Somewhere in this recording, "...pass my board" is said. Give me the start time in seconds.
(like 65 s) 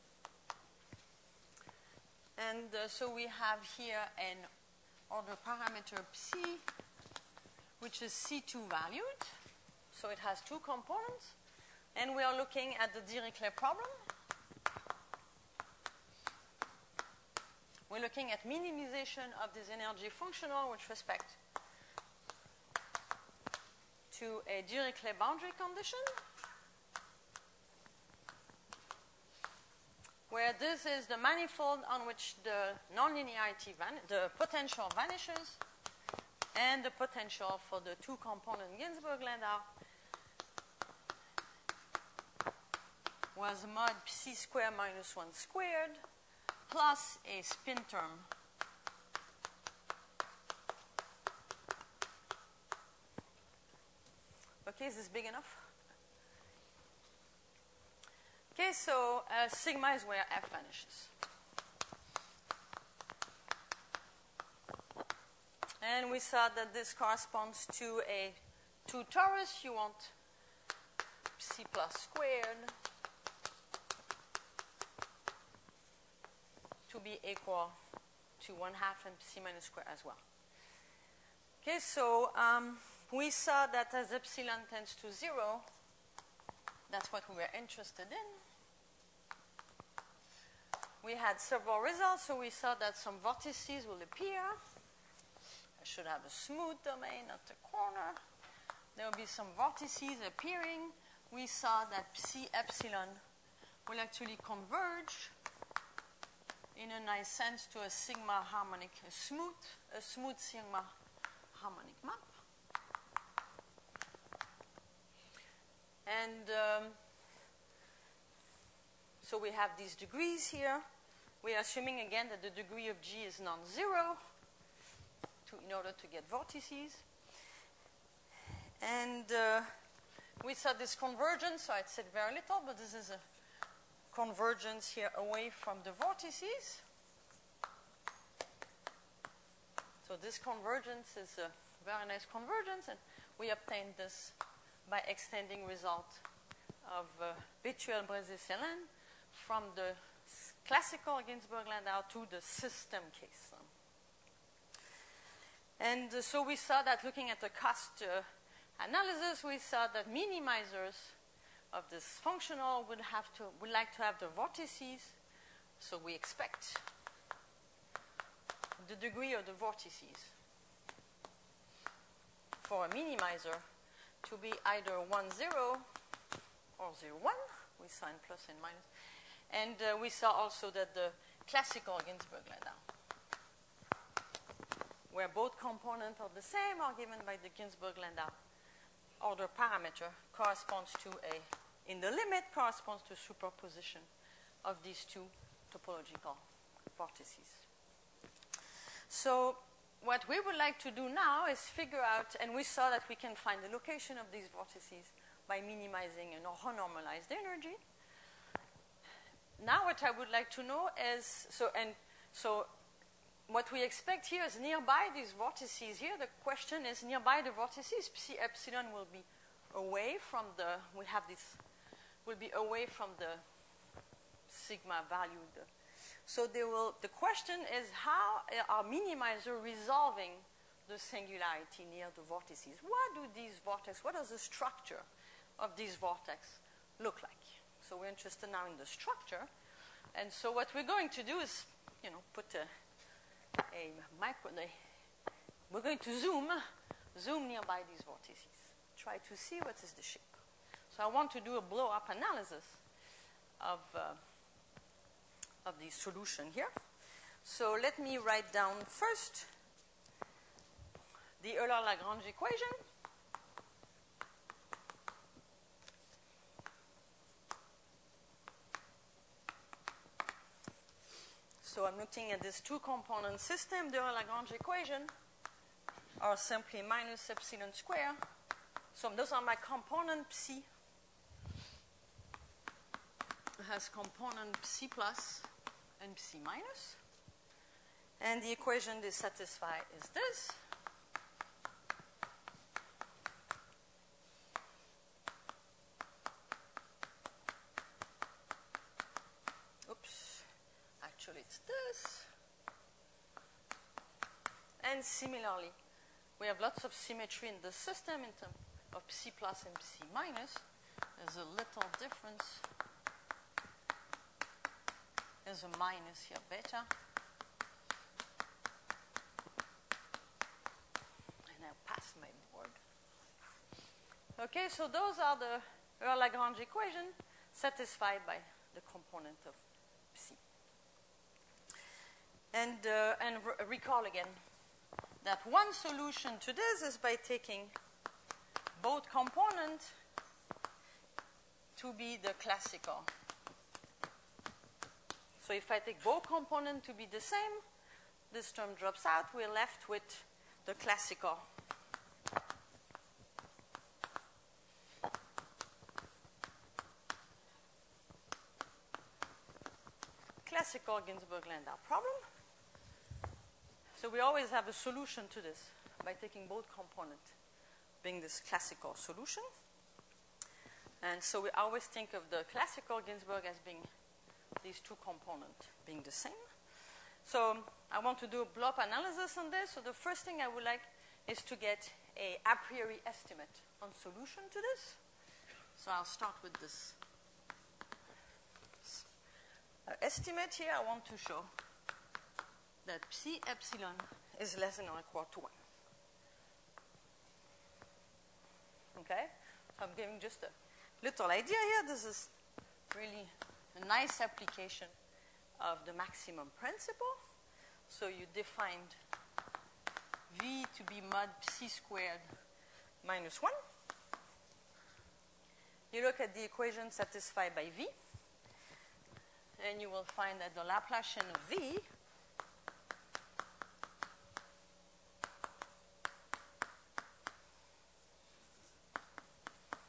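321 s.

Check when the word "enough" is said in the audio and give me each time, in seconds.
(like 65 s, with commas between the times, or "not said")
55 s.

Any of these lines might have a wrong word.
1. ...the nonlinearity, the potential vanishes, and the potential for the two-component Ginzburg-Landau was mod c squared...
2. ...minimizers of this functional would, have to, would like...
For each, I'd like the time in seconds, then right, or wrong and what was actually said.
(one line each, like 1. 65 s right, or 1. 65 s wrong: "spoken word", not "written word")
1. 32 s right
2. 160 s right.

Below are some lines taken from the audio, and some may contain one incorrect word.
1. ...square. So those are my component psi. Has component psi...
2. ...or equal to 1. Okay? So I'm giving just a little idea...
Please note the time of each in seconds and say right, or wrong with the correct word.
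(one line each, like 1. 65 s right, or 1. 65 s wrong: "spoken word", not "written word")
1. 277 s right
2. 394 s right.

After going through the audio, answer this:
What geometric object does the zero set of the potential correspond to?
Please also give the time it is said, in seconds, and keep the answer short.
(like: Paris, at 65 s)
2 torus, at 68 s.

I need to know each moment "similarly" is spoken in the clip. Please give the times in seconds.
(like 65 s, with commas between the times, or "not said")
305 s.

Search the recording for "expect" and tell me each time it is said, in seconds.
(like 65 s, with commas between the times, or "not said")
166 s, 213 s.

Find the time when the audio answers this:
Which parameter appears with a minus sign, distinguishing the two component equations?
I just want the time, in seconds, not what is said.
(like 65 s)
316 s.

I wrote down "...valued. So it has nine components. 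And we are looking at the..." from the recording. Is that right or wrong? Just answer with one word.
wrong.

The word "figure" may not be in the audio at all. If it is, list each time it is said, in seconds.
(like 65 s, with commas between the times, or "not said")
201 s.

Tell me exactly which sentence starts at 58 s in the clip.
Okay, so uh, sigma is where f vanishes.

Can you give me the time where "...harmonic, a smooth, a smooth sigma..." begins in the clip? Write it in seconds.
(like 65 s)
108 s.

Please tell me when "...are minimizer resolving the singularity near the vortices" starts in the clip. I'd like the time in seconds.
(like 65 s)
228 s.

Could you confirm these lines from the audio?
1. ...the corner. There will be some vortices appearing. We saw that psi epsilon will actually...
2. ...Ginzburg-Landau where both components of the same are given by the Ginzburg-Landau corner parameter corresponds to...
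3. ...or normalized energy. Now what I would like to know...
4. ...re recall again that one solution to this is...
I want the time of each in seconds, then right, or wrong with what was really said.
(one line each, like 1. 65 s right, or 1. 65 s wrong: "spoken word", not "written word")
1. 97 s right
2. 182 s wrong: "order", not "corner"
3. 206 s right
4. 333 s right.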